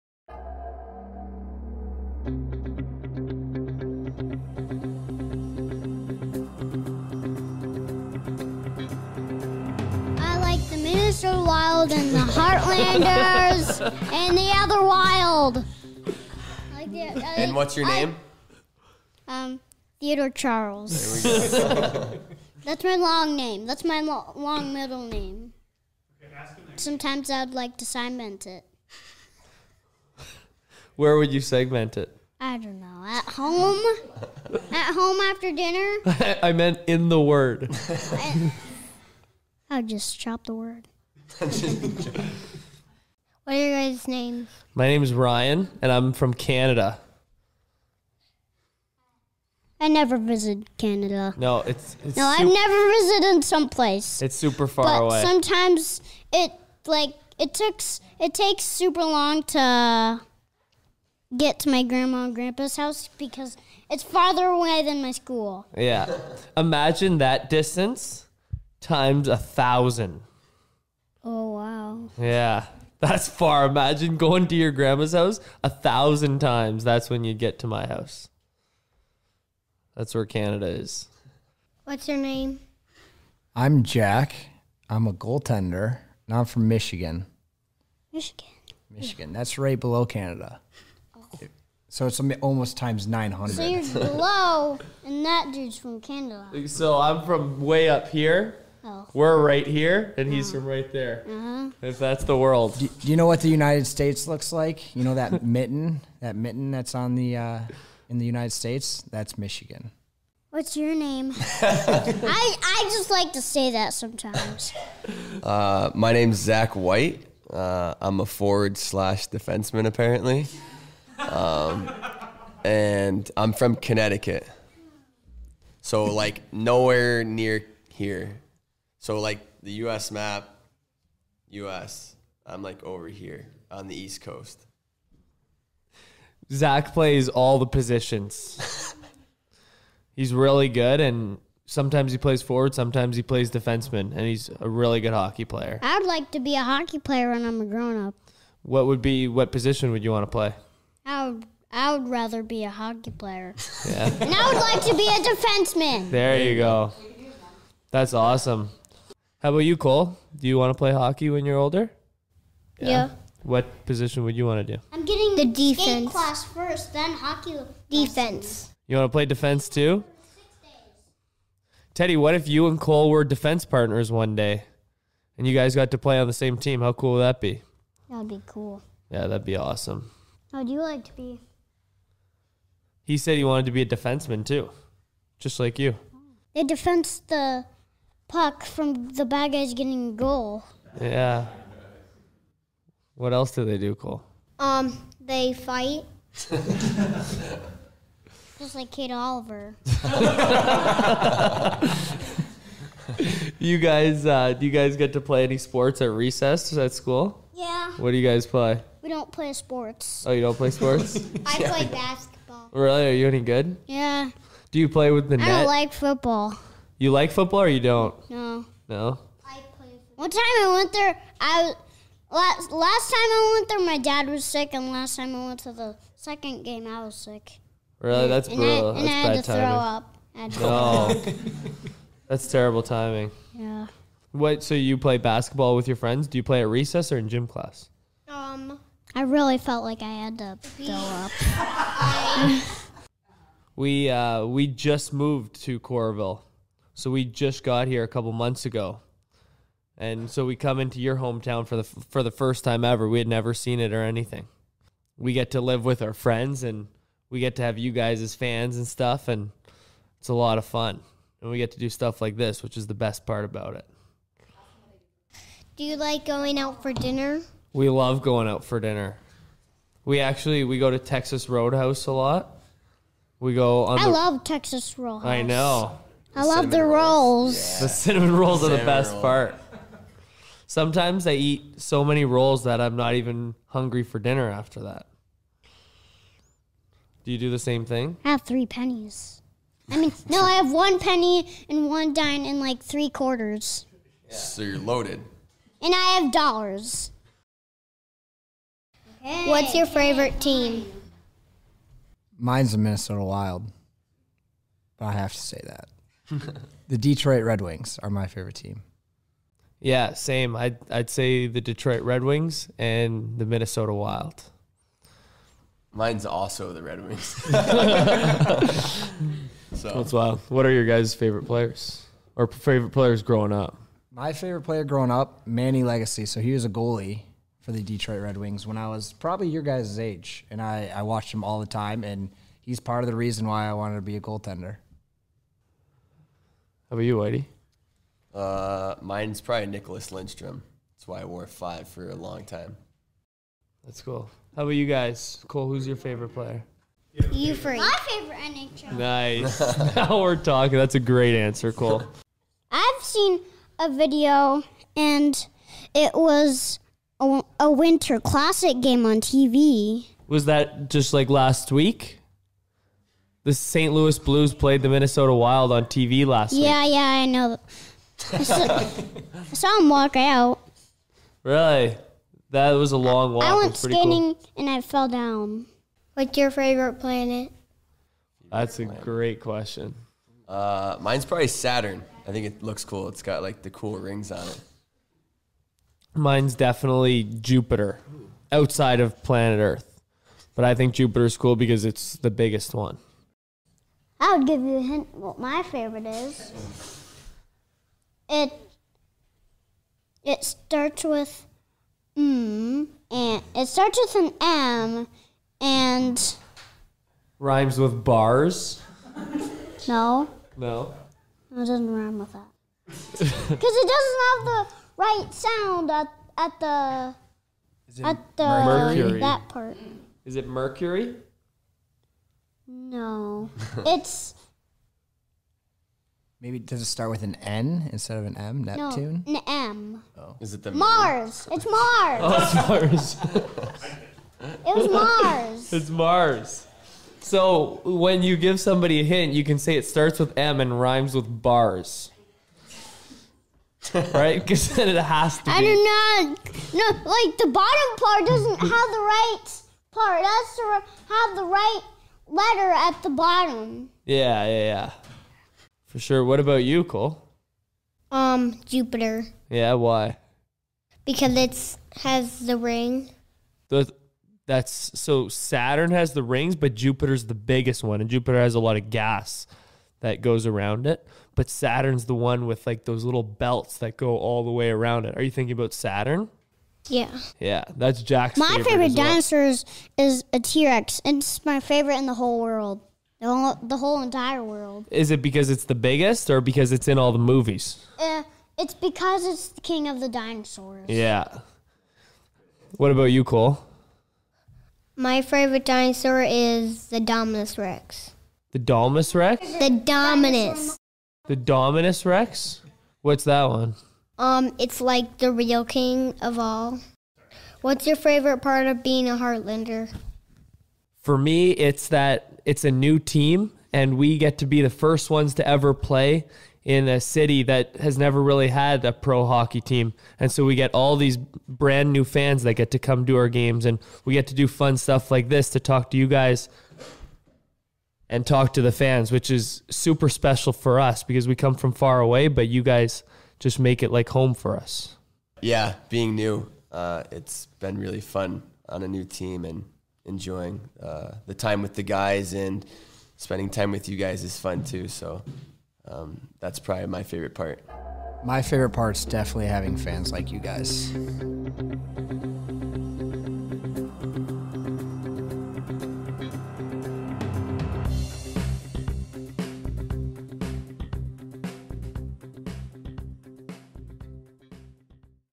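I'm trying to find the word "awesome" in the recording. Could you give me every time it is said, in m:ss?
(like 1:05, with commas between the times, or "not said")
2:38, 2:59.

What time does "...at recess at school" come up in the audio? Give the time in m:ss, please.
3:26.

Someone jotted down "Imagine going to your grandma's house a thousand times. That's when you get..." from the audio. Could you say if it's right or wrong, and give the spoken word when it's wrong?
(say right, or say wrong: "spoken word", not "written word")
right.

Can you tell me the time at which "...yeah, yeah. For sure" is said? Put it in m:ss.
7:34.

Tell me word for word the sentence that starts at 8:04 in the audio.
Is it because it's the biggest, or because it's in all the movies?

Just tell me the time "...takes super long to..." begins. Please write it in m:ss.
0:58.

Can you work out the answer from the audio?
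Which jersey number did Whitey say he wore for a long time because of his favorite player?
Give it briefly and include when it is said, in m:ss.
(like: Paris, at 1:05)
5, at 5:41.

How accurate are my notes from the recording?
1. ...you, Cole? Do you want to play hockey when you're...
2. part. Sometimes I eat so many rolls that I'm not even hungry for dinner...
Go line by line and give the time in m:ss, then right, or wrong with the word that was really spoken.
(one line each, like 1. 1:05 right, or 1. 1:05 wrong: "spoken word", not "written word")
1. 2:39 right
2. 4:39 right.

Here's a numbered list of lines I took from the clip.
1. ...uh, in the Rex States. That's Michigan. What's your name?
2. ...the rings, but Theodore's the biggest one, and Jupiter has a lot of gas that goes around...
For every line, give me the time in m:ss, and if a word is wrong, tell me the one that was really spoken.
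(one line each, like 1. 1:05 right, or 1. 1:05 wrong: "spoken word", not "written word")
1. 1:47 wrong: "United", not "Rex"
2. 7:46 wrong: "Jupiter", not "Theodore".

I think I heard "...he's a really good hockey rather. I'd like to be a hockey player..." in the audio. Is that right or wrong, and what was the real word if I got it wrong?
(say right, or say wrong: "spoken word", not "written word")
wrong: "player", not "rather".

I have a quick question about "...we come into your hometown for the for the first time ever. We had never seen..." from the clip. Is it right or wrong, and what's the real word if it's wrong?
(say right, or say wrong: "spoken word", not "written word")
right.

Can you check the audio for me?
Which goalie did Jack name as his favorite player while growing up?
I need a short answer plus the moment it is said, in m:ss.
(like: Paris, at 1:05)
Manny Legace, at 5:25.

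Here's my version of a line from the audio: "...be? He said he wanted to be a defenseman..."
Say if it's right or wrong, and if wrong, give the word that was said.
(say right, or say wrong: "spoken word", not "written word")
right.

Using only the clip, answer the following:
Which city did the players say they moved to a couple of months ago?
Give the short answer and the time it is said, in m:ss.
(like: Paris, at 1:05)
Coralville, at 4:05.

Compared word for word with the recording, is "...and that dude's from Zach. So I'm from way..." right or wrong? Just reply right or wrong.
wrong.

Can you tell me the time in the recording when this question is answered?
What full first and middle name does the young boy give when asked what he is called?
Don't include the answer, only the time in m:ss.
0:19.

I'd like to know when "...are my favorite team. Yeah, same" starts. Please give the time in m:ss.
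5:08.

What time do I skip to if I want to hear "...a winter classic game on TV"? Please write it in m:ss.
5:57.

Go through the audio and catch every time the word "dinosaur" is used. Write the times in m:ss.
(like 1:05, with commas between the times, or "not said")
7:58, 8:10, 8:15.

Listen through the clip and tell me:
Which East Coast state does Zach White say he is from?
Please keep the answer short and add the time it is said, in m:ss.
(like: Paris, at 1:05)
Connecticut, at 2:03.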